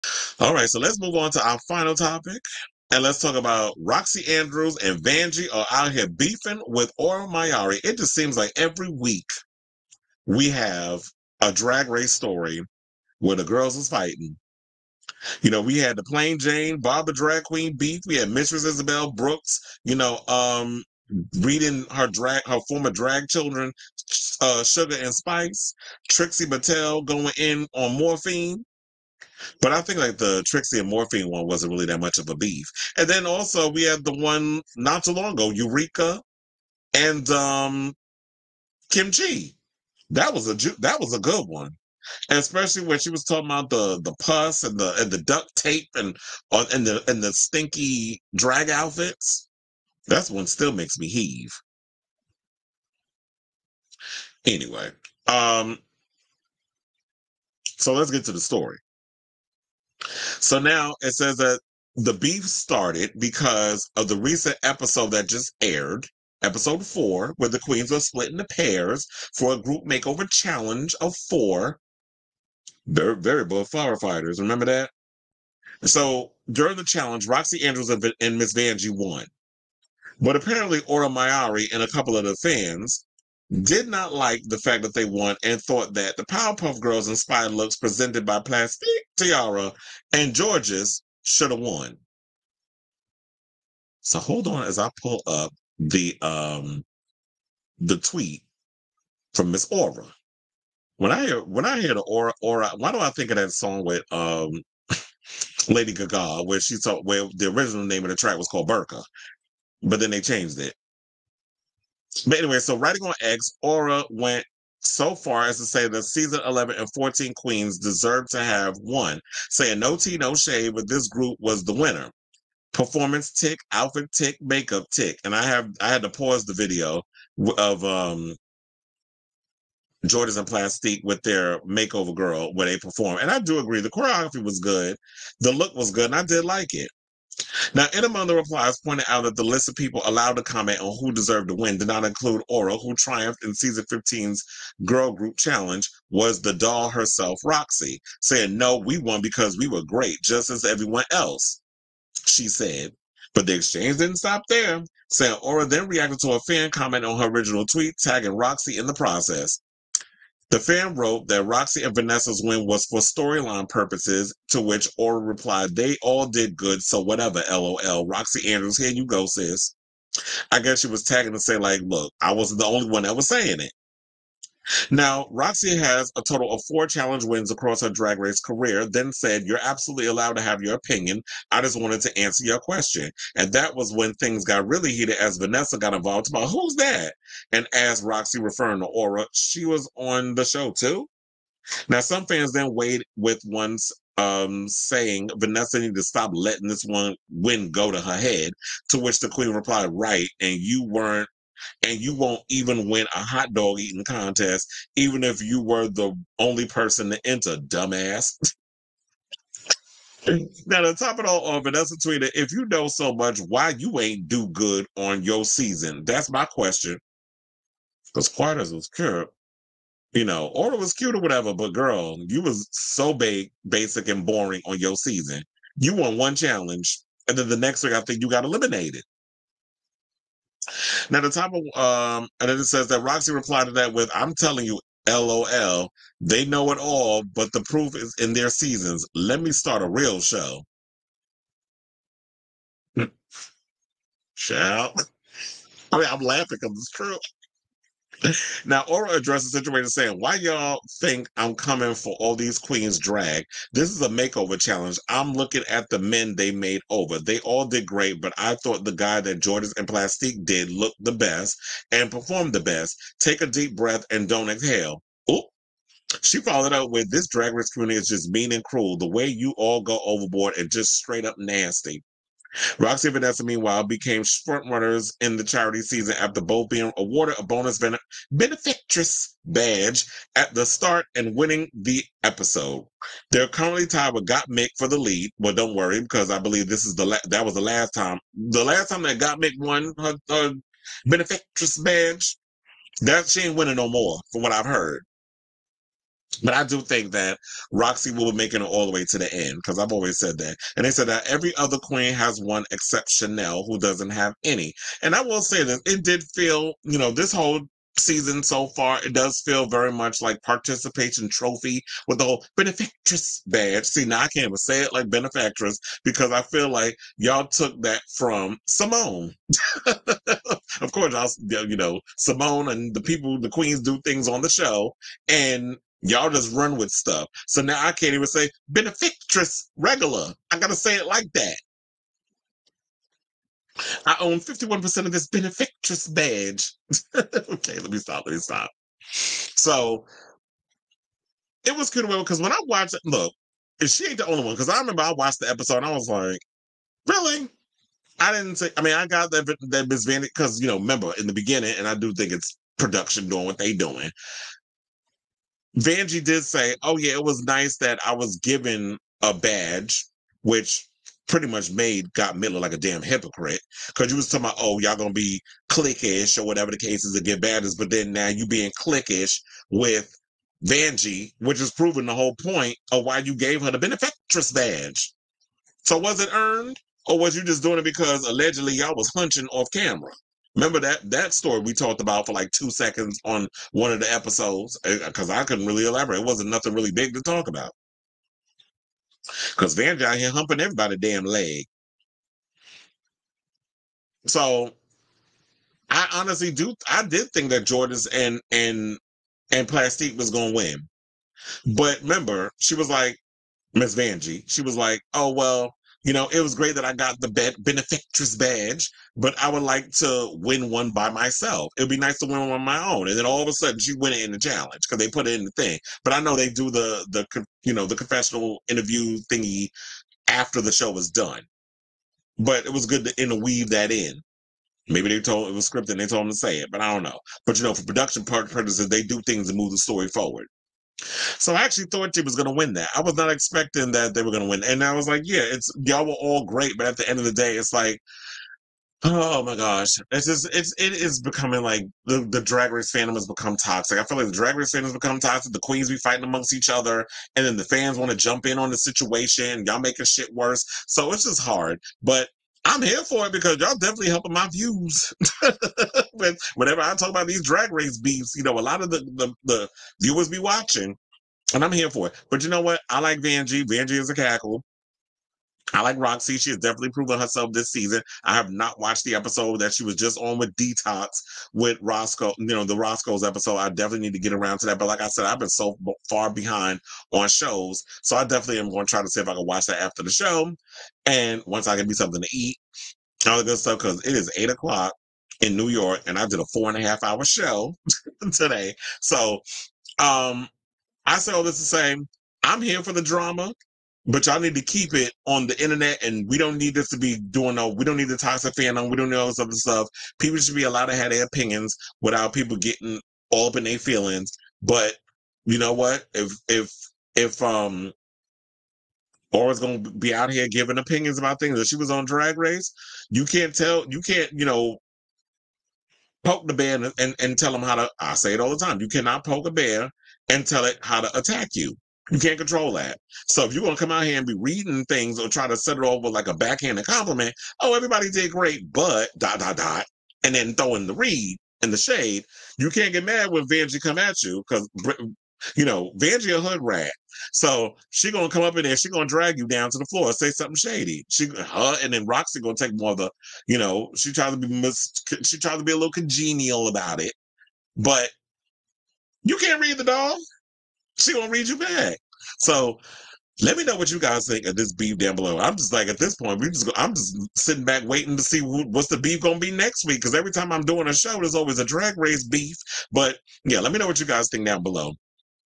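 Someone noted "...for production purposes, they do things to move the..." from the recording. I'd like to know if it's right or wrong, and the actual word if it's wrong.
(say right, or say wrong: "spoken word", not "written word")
right.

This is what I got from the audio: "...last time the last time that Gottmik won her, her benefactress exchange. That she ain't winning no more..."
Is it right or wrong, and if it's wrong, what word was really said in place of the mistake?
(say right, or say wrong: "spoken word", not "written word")
wrong: "badge", not "exchange".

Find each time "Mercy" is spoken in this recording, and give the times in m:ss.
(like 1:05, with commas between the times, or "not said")
not said.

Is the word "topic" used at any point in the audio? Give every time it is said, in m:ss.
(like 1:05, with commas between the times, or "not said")
0:01.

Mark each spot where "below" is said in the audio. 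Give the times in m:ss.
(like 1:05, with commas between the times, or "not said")
9:15, 9:24.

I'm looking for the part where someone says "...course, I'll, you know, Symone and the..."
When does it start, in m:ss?
5:20.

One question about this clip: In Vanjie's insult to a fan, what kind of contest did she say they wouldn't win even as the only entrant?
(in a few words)
Hot dog eating contest.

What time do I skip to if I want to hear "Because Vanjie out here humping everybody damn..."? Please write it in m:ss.
6:29.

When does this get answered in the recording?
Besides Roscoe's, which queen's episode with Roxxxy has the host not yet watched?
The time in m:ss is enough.
7:50.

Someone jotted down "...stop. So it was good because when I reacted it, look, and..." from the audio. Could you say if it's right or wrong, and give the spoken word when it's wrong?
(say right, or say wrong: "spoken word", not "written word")
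wrong: "watched", not "reacted".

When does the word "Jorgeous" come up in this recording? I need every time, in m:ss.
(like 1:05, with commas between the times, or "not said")
1:30, 2:10, 4:19, 6:37.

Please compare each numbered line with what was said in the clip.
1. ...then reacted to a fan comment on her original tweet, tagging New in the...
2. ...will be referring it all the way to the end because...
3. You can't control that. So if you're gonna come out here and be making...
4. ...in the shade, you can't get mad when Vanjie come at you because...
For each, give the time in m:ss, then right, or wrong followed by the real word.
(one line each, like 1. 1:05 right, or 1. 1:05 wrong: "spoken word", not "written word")
1. 2:35 wrong: "Roxxxy", not "New"
2. 4:58 wrong: "making", not "referring"
3. 8:42 wrong: "reading", not "making"
4. 8:51 right.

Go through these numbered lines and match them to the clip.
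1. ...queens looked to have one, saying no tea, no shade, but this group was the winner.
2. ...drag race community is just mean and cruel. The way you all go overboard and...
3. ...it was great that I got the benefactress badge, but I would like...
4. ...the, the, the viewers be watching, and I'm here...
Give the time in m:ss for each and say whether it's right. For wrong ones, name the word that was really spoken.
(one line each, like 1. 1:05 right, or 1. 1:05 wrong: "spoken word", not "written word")
1. 1:57 wrong: "deserved", not "looked"
2. 4:27 right
3. 6:46 right
4. 7:38 right.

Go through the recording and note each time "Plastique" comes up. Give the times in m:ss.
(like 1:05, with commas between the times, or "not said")
1:28, 2:10, 4:19, 6:39.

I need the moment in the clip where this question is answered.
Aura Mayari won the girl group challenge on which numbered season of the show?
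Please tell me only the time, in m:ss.
2:23.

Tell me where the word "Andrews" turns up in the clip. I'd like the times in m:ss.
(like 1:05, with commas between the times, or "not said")
0:04, 1:17, 2:48.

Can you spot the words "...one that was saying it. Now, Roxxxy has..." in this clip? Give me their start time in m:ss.
2:52.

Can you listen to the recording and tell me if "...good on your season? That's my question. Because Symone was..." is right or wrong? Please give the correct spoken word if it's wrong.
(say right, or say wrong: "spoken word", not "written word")
wrong: "Quarters", not "Symone".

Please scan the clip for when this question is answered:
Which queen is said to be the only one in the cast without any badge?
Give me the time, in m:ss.
5:03.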